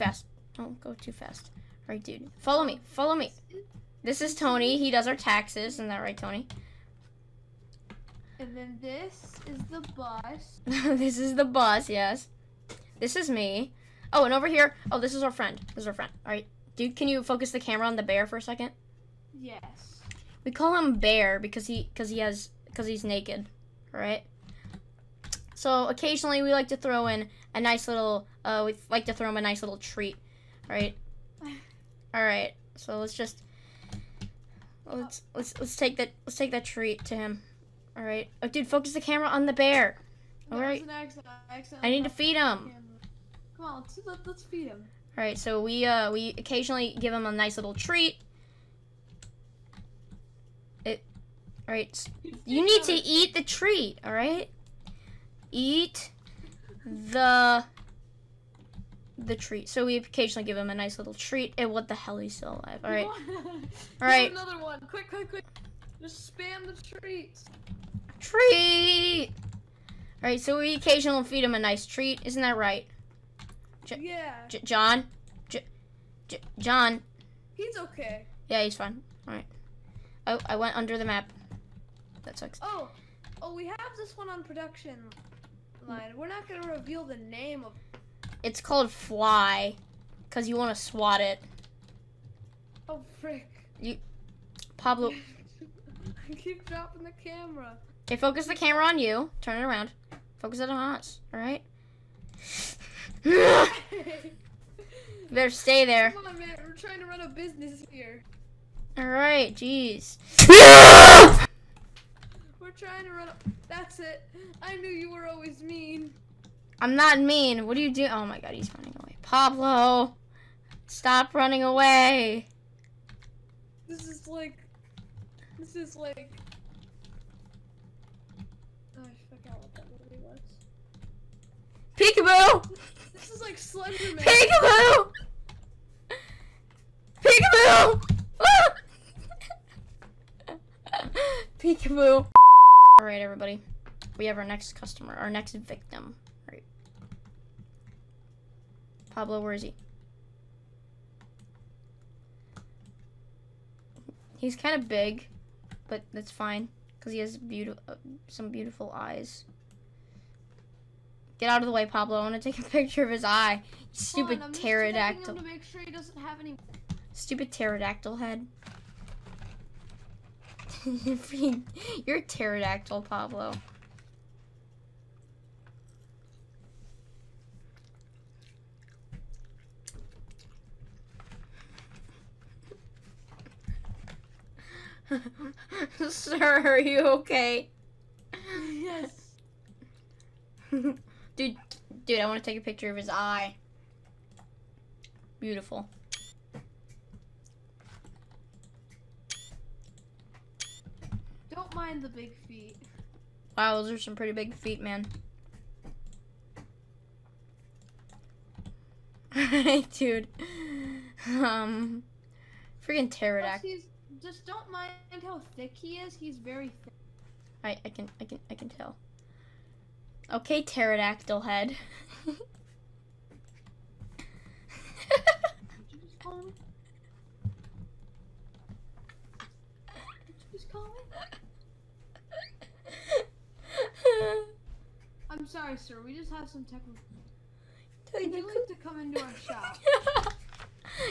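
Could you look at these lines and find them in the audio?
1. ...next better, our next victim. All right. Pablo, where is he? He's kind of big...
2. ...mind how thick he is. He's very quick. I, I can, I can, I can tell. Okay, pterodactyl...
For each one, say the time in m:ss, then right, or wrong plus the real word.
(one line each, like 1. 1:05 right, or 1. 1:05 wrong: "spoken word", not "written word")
1. 2:24 wrong: "customer", not "better"
2. 3:34 wrong: "thick", not "quick".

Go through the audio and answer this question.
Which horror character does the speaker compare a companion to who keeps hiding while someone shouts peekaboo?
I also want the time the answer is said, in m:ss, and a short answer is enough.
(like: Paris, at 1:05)
Slenderman, at 2:13.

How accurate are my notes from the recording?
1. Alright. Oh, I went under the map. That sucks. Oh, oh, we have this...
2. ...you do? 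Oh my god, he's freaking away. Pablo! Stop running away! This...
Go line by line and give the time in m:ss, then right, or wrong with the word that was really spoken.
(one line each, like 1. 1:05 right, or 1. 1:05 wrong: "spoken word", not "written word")
1. 1:19 right
2. 1:57 wrong: "running", not "freaking".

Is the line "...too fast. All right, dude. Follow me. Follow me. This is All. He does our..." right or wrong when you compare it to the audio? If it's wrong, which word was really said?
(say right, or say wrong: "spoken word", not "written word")
wrong: "Tony", not "All".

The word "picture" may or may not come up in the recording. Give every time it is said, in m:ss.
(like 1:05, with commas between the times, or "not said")
2:42, 3:12.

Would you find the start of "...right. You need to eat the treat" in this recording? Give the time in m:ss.
0:51.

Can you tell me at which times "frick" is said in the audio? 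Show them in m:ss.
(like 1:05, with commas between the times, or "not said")
1:33.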